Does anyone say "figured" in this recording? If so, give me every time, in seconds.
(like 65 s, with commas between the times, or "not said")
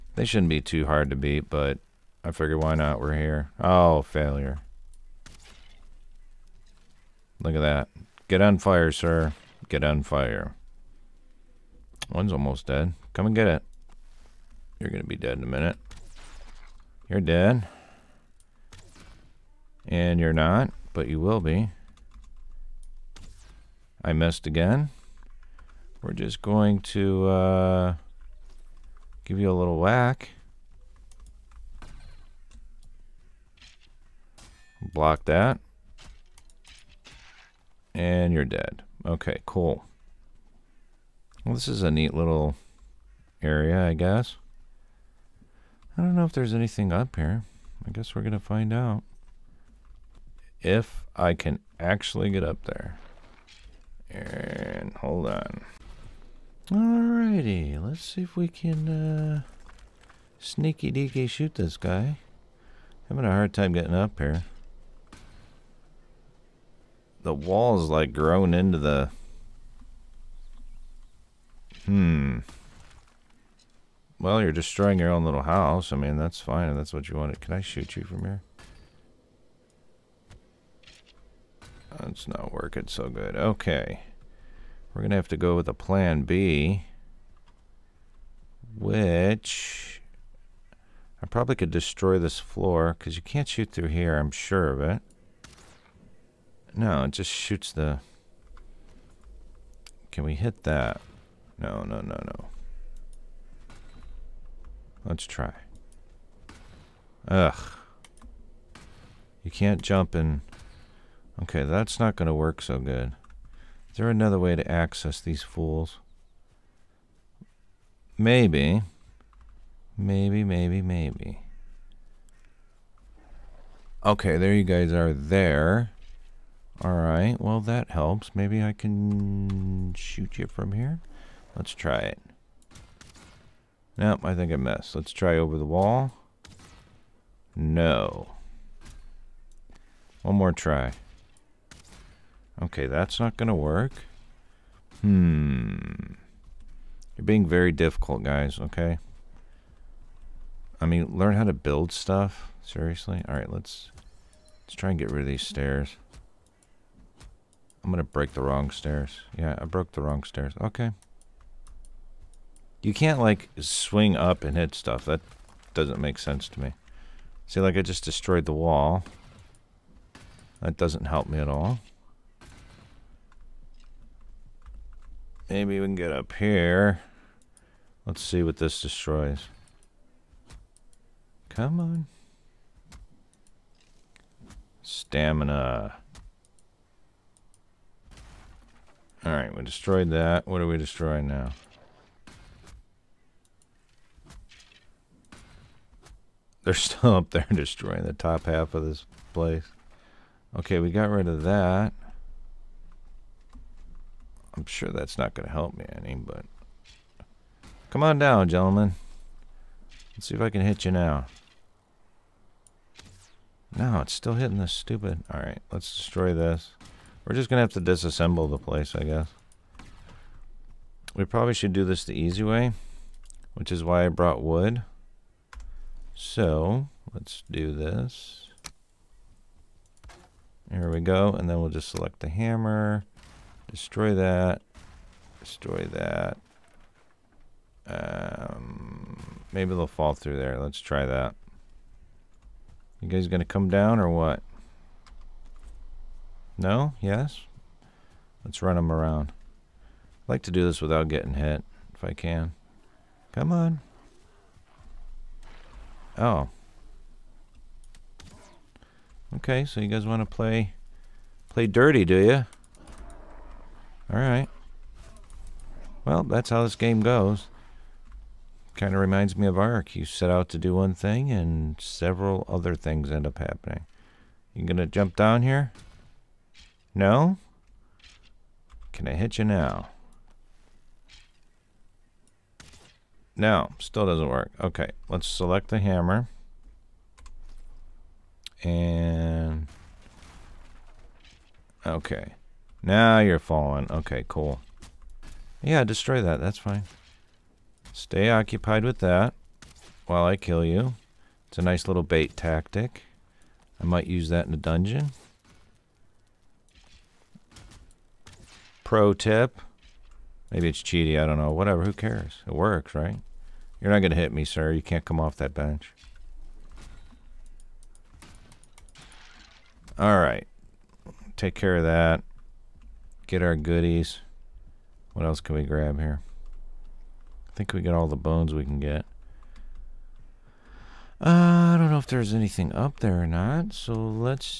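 2 s.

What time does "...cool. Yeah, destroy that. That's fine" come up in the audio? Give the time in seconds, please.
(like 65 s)
294 s.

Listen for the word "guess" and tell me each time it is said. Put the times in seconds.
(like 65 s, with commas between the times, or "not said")
43 s, 47 s, 219 s.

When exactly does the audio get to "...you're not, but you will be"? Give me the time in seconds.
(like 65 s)
20 s.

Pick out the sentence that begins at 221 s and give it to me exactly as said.
We probably should do this the easy way, which is why I brought wood.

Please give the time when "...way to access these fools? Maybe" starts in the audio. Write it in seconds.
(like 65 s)
114 s.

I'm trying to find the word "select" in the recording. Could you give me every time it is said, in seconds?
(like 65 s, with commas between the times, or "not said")
231 s, 285 s.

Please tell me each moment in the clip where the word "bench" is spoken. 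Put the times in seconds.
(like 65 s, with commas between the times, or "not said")
315 s.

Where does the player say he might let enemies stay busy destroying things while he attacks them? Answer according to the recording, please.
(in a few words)
in a dungeon.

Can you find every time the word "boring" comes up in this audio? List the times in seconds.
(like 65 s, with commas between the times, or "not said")
not said.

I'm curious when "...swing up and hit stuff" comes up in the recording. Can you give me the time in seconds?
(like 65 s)
163 s.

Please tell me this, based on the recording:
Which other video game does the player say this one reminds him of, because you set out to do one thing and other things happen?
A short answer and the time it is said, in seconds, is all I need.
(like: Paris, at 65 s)
Ark, at 269 s.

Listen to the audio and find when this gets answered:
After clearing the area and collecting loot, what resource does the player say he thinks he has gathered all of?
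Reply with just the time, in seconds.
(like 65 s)
328 s.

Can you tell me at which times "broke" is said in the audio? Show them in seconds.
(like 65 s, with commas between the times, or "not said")
159 s.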